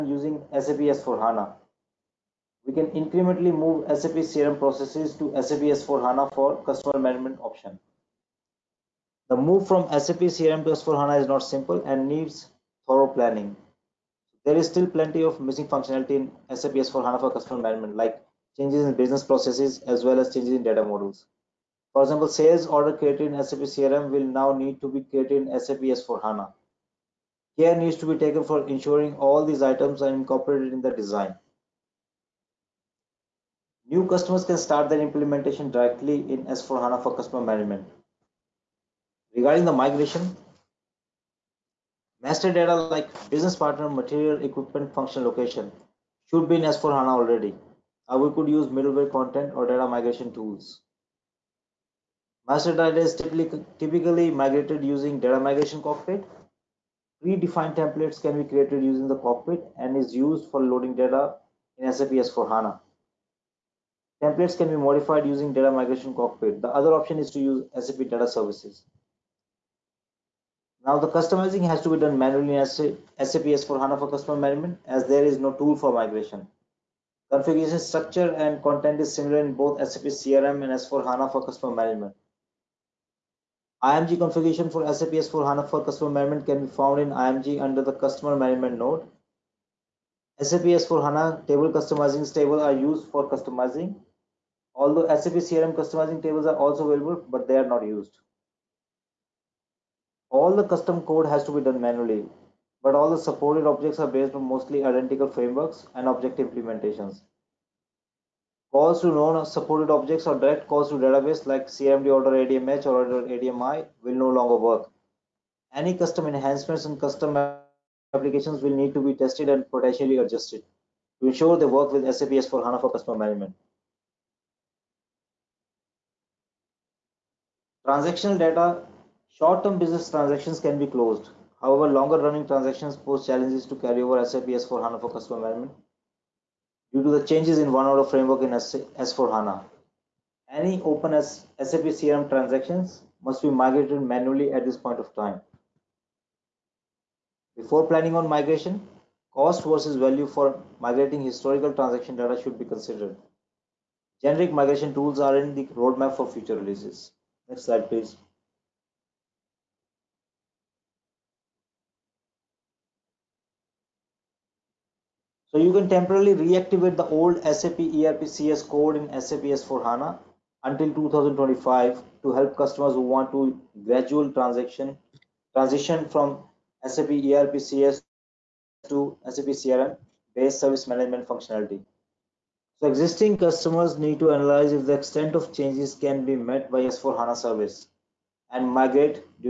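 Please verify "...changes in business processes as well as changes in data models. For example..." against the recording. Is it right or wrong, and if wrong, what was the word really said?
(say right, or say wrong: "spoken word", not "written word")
right.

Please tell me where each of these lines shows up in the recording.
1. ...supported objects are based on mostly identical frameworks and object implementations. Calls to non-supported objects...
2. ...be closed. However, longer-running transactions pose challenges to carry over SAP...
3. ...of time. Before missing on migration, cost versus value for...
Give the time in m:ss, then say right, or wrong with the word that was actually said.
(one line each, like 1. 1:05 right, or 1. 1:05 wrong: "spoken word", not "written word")
1. 1:43 right
2. 2:10 right
3. 2:24 wrong: "planning", not "missing".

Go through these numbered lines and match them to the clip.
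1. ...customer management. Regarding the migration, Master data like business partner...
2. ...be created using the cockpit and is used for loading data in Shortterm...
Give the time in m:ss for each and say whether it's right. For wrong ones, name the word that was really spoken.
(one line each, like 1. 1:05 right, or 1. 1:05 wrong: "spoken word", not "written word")
1. 0:37 right
2. 0:58 wrong: "SAP", not "Shortterm".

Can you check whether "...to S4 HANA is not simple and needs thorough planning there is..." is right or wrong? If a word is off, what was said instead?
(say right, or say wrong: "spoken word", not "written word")
right.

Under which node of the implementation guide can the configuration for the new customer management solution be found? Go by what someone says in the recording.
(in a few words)
Customer management node.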